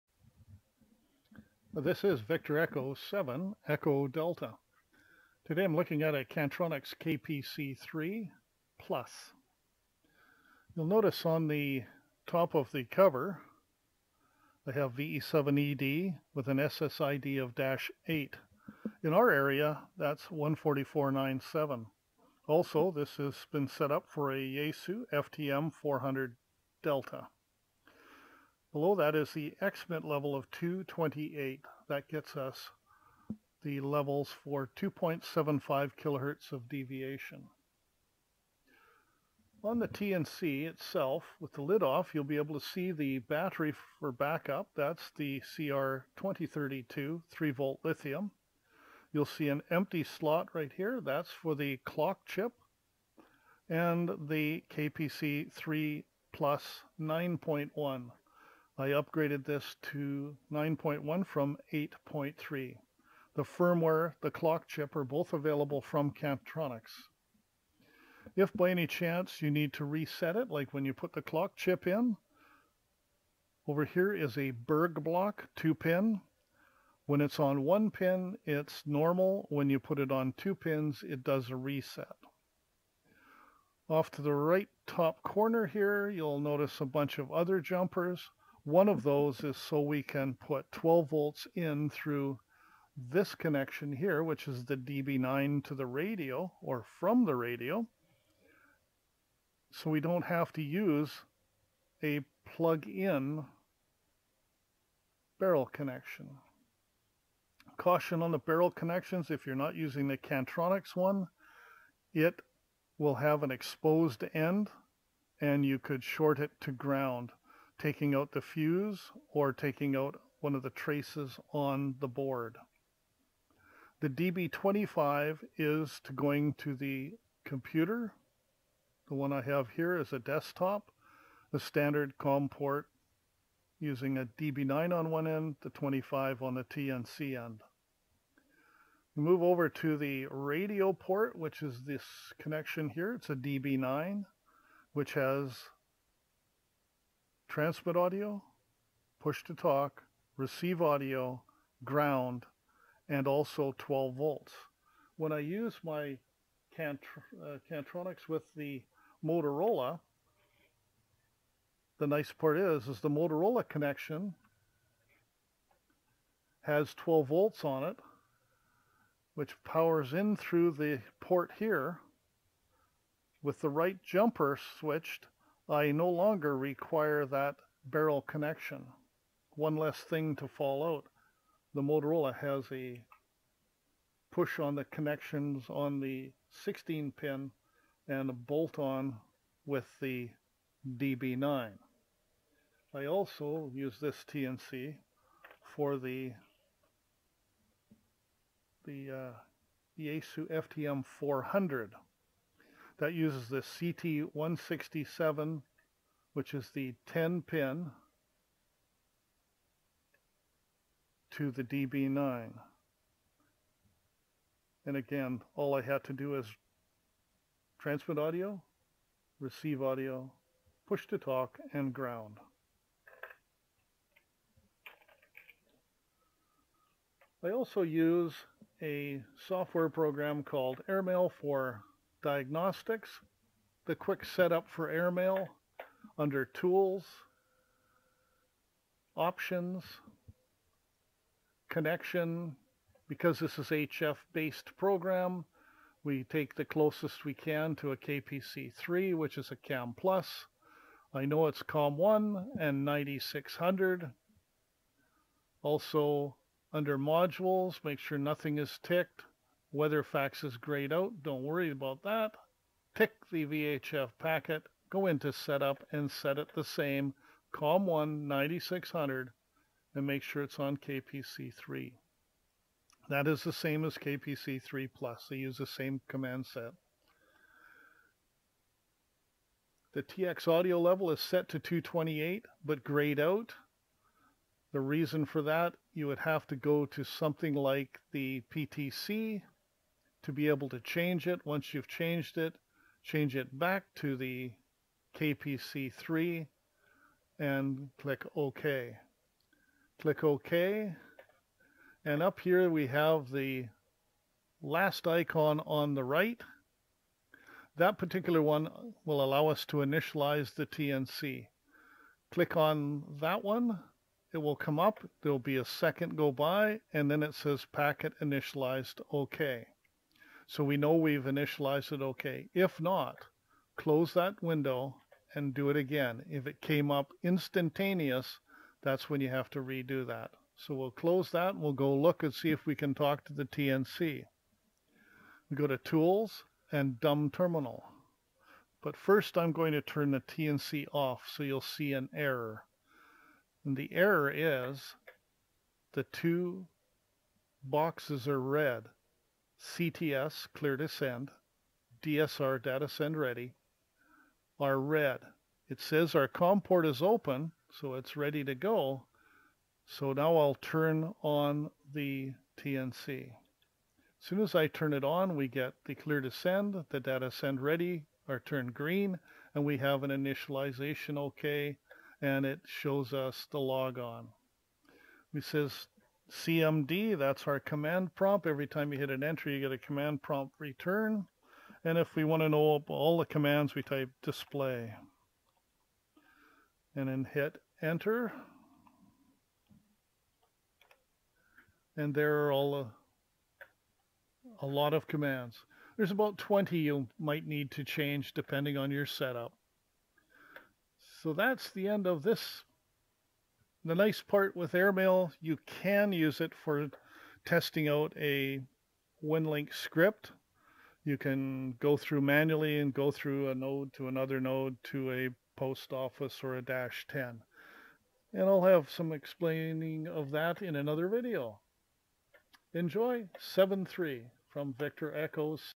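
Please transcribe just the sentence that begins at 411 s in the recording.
You can go through manually and go through a node to another node to a post office or a dash 10.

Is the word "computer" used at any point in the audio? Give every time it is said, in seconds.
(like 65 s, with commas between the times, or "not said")
127 s.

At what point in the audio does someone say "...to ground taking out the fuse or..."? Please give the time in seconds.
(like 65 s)
116 s.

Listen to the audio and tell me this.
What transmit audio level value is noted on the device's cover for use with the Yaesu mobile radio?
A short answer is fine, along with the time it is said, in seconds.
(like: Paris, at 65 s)
228, at 29 s.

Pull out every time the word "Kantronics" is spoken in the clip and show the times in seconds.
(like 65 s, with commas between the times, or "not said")
6 s, 66 s, 110 s, 157 s.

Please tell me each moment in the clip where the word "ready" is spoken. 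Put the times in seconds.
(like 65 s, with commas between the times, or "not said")
353 s, 358 s, 367 s.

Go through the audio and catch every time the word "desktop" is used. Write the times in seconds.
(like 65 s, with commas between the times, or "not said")
130 s.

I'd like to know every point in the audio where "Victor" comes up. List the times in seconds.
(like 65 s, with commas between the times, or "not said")
2 s, 424 s.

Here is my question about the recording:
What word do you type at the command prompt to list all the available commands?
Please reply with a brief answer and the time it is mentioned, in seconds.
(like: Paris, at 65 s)
display, at 384 s.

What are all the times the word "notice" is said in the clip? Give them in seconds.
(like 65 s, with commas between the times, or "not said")
10 s, 86 s.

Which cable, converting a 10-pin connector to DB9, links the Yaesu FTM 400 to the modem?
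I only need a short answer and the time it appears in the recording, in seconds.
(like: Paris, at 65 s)
CT167, at 203 s.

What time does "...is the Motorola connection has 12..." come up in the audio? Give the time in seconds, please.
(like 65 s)
162 s.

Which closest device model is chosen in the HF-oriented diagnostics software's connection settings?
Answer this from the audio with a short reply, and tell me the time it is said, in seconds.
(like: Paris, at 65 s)
KAM Plus, at 249 s.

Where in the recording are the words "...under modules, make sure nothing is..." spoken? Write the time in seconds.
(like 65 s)
256 s.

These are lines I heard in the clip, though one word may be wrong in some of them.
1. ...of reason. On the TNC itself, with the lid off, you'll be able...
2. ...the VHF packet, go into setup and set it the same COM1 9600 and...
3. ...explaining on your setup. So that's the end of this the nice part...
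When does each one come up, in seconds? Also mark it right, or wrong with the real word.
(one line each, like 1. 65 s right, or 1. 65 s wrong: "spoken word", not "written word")
1. 36 s wrong: "deviation", not "reason"
2. 263 s right
3. 398 s wrong: "depending", not "explaining".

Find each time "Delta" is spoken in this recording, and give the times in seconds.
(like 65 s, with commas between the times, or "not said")
4 s, 26 s.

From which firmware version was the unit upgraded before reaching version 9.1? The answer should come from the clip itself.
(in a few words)
8.3.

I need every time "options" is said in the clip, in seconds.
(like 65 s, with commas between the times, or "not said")
239 s.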